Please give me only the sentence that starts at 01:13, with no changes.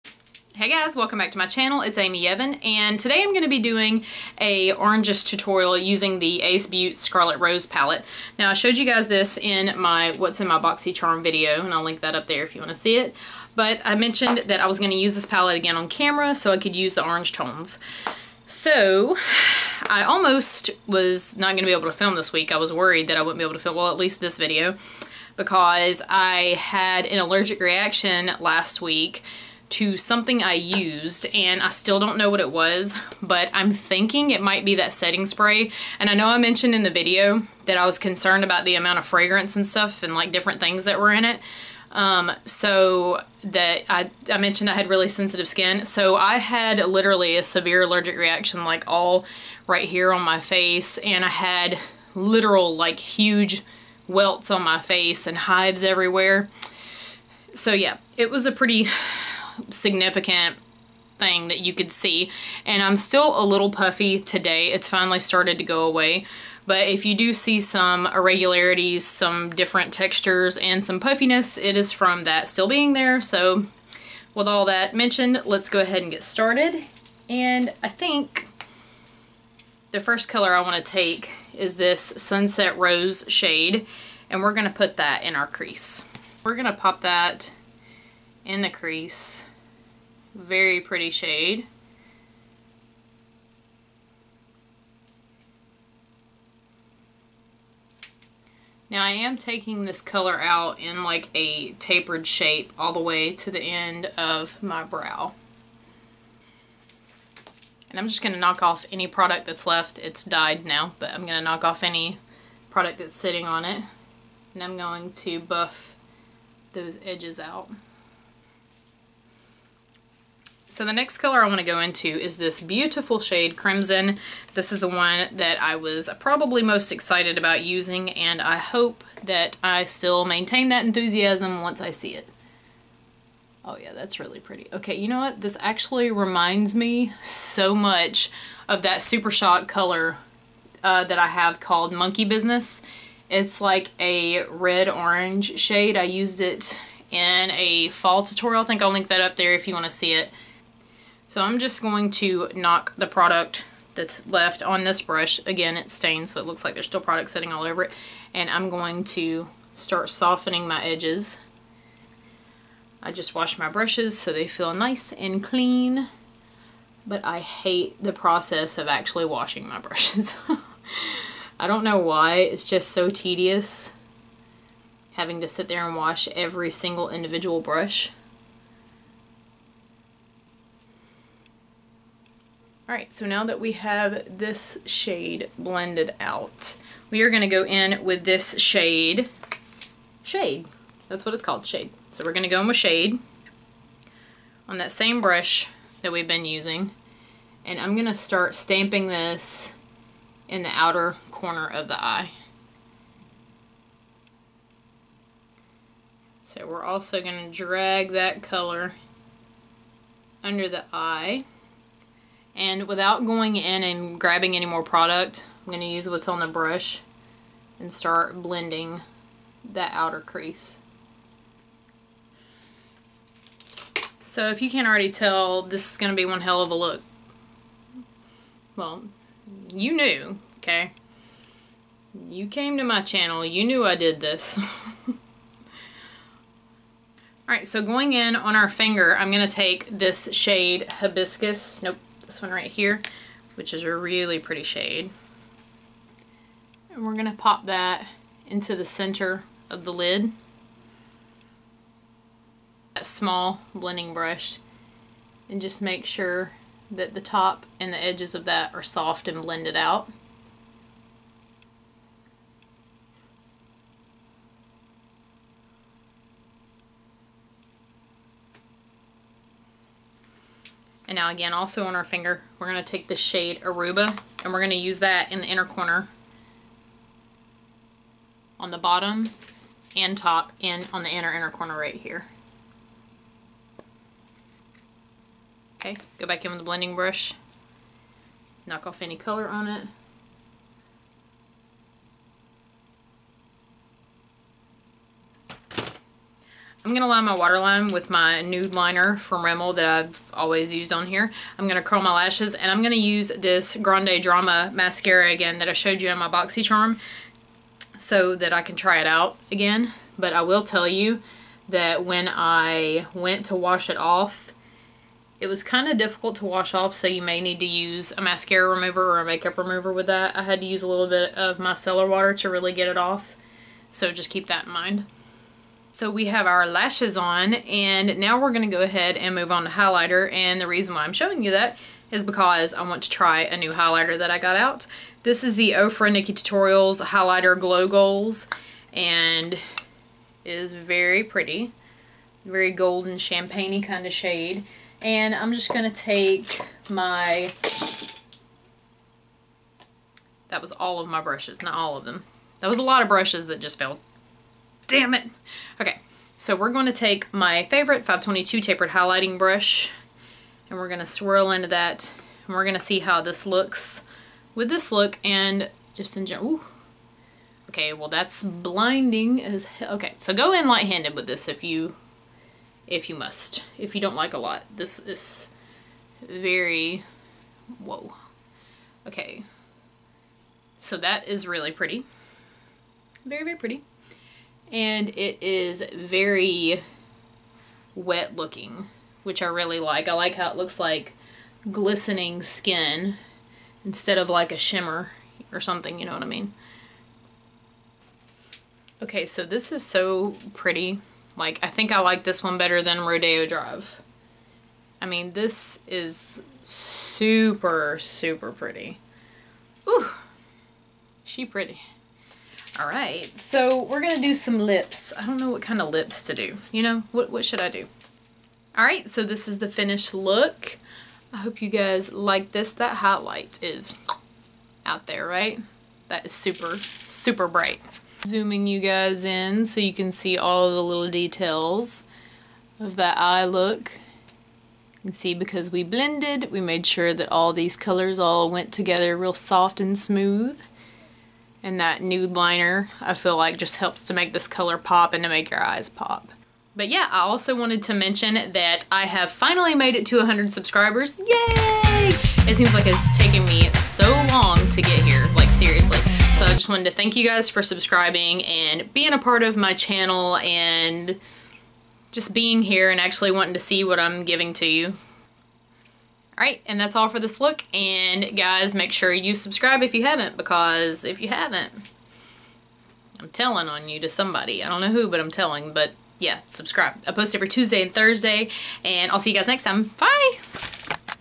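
So with all that mentioned, let's go ahead and get started.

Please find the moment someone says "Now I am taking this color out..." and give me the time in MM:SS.
01:38.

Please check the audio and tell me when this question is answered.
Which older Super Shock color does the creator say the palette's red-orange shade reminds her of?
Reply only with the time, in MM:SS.
02:21.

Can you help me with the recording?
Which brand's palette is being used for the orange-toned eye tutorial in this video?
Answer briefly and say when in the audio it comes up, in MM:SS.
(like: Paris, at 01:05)
Ace Beaute, at 00:06.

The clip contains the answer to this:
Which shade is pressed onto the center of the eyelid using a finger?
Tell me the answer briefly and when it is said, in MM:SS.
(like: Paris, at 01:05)
Hibiscus, at 04:00.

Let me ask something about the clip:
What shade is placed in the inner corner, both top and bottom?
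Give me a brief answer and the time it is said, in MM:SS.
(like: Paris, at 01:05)
Aruba, at 04:33.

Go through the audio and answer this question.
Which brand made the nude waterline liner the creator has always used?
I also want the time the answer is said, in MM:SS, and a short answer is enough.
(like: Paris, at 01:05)
Rimmel, at 04:59.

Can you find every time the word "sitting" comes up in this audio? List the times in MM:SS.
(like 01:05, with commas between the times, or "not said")
01:53, 02:37.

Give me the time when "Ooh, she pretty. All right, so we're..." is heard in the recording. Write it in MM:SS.
06:49.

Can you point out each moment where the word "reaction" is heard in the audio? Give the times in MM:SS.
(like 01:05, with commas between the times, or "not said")
00:27, 00:48.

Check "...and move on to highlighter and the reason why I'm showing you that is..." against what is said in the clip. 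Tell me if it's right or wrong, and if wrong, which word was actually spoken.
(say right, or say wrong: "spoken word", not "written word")
right.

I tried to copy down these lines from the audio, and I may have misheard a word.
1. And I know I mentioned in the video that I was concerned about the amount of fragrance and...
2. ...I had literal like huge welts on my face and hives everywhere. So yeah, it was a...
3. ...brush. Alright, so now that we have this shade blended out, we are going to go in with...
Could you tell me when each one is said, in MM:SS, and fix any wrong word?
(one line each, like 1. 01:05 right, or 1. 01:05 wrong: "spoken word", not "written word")
1. 00:35 right
2. 00:51 right
3. 02:57 right.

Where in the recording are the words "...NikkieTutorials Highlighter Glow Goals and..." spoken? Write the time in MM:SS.
05:36.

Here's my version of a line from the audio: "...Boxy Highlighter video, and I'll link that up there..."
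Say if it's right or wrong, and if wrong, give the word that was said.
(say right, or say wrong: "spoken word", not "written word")
wrong: "Charm", not "Highlighter".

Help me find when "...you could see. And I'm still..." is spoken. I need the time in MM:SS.
01:01.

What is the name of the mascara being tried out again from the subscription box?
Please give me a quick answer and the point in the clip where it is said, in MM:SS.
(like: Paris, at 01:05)
Grande Drama, at 05:03.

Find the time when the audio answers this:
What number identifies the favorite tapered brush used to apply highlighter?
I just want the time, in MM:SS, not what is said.
05:58.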